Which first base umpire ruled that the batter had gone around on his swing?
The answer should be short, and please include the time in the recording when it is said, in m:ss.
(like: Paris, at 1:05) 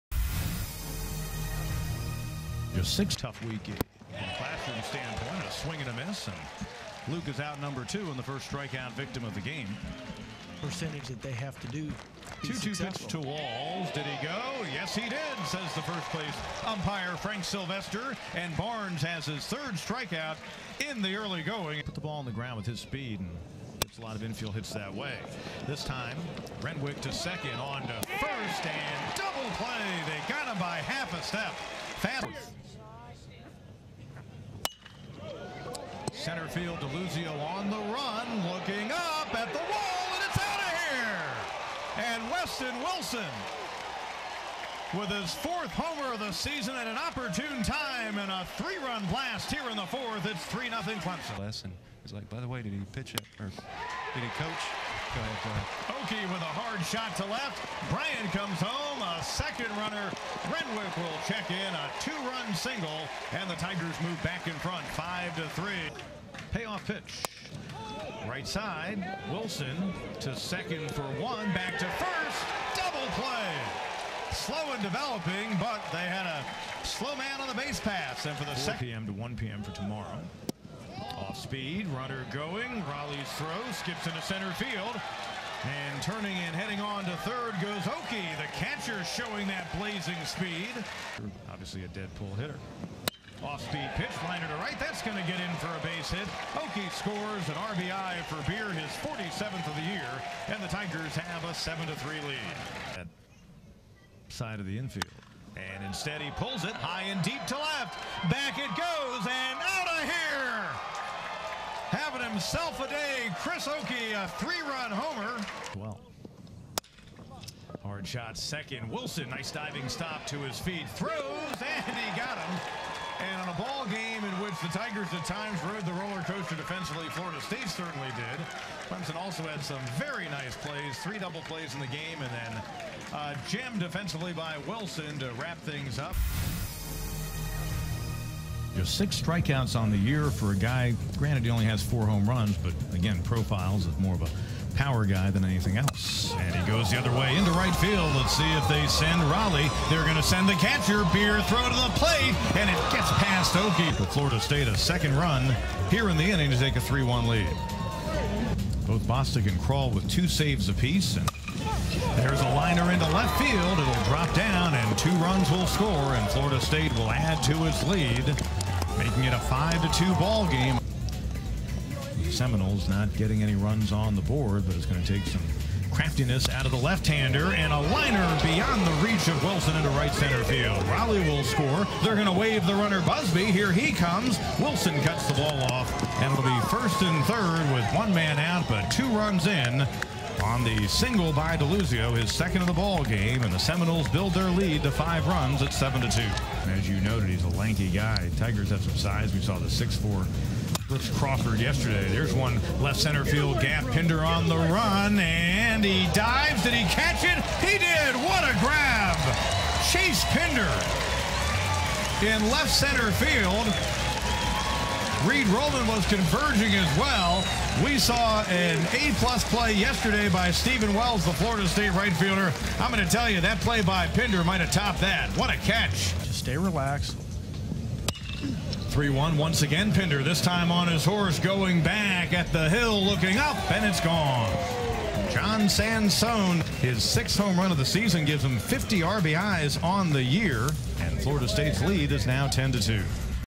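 Frank Sylvester, at 0:17.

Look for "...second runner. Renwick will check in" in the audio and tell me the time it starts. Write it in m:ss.
0:59.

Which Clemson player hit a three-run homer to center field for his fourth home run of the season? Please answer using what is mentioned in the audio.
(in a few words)
Weston Wilson.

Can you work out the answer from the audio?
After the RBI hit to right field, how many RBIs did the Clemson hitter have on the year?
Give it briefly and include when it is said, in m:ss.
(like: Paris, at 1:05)
47, at 1:39.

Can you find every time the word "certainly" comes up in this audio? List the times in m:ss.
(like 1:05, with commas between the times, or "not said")
2:07.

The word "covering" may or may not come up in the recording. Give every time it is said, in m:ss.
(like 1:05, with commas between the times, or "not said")
not said.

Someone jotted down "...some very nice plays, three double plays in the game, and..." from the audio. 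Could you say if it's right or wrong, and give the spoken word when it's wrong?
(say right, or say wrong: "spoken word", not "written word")
right.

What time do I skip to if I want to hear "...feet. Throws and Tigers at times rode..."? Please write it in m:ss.
2:00.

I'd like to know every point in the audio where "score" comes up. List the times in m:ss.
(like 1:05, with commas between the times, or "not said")
1:36, 2:45, 3:01.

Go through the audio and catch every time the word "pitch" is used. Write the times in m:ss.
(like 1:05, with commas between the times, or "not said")
0:13, 0:52, 1:06, 1:33.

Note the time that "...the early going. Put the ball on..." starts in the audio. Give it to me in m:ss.
0:21.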